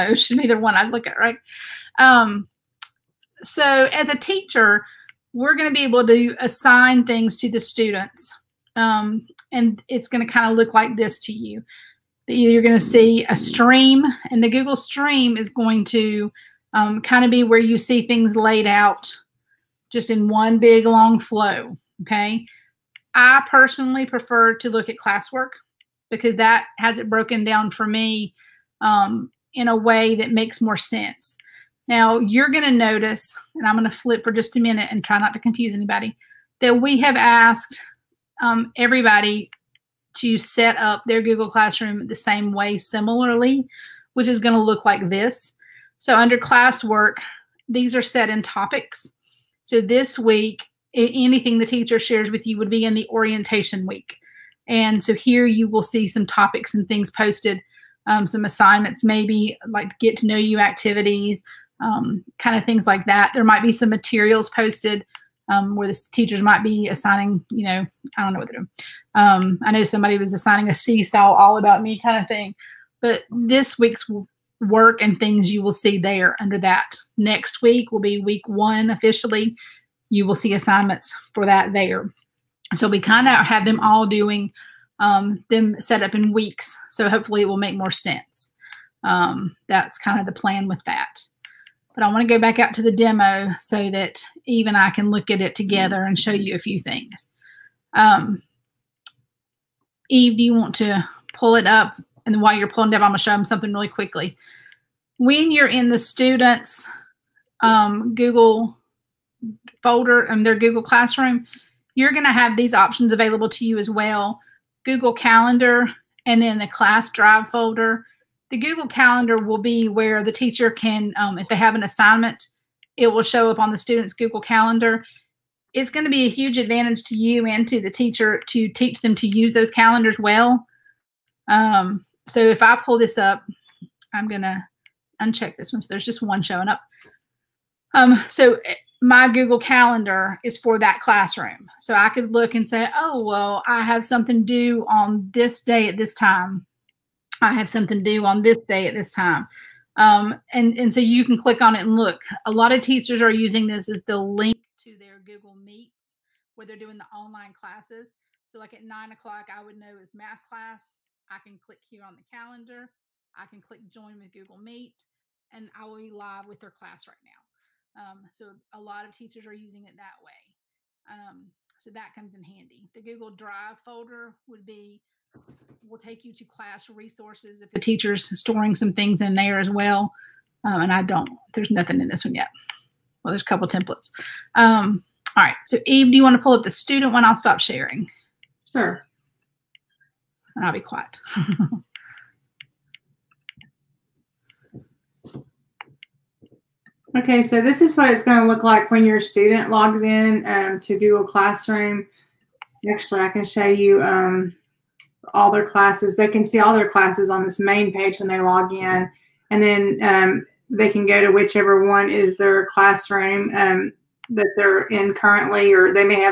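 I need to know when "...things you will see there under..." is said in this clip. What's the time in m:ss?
1:15.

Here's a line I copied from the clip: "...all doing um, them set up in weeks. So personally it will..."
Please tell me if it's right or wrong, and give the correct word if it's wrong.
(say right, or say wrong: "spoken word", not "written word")
wrong: "hopefully", not "personally".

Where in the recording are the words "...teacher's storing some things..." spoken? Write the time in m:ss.
2:57.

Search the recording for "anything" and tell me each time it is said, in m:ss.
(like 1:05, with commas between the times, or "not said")
0:50.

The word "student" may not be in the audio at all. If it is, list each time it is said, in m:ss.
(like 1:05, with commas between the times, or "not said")
0:07, 1:45, 2:03, 3:06, 3:19.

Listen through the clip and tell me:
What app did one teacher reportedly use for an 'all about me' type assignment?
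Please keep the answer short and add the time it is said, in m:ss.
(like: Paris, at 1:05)
Seesaw, at 1:10.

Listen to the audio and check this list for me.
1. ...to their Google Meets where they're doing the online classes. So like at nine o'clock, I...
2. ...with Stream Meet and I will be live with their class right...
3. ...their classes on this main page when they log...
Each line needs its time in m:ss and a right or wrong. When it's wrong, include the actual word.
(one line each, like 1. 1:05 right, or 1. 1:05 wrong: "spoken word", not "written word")
1. 2:34 right
2. 2:44 wrong: "Google", not "Stream"
3. 3:26 right.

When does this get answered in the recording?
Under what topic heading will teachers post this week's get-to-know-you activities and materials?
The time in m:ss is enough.
0:53.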